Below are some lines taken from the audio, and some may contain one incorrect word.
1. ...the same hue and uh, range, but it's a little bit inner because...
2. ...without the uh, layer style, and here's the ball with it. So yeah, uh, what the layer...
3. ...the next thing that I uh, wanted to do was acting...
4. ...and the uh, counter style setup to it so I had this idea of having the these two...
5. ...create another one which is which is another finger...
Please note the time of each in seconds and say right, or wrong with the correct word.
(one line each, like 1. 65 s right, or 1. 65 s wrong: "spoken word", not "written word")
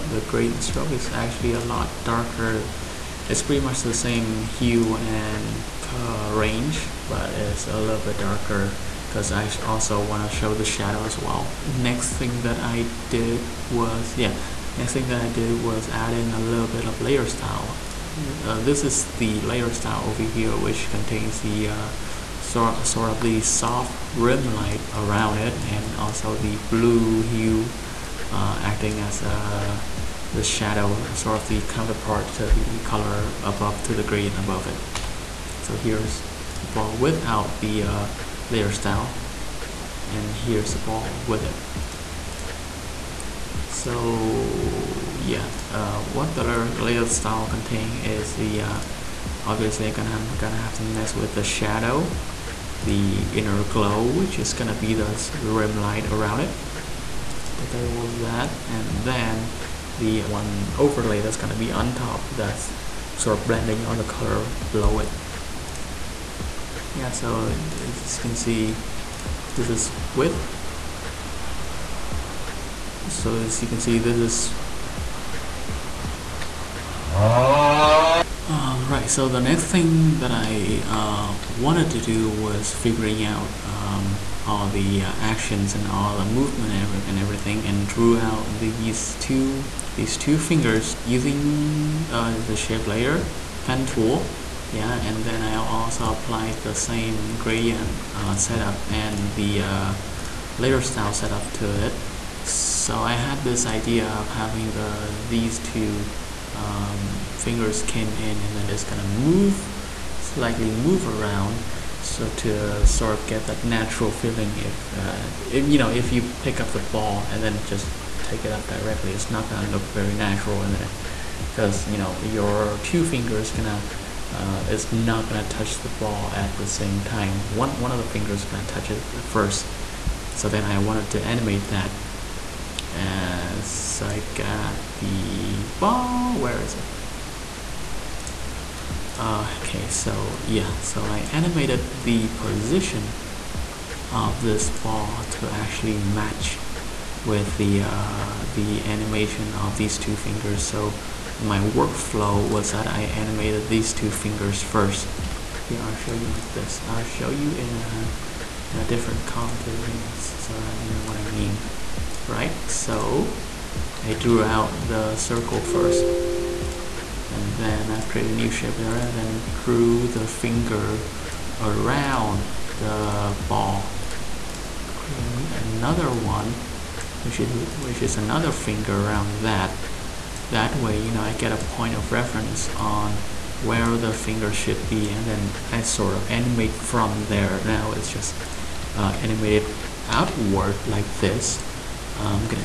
1. 3 s wrong: "darker", not "inner"
2. 36 s right
3. 79 s wrong: "figuring", not "acting"
4. 98 s wrong: "layer", not "counter"
5. 174 s right.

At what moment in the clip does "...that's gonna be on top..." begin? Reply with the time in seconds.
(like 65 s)
61 s.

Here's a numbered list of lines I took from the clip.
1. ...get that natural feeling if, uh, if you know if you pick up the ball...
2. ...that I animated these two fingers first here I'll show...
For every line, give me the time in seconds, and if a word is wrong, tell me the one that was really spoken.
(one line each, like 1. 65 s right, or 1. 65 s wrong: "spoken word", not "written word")
1. 113 s right
2. 152 s right.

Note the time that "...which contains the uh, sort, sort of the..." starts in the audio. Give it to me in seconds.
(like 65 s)
20 s.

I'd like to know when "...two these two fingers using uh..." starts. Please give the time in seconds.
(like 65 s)
89 s.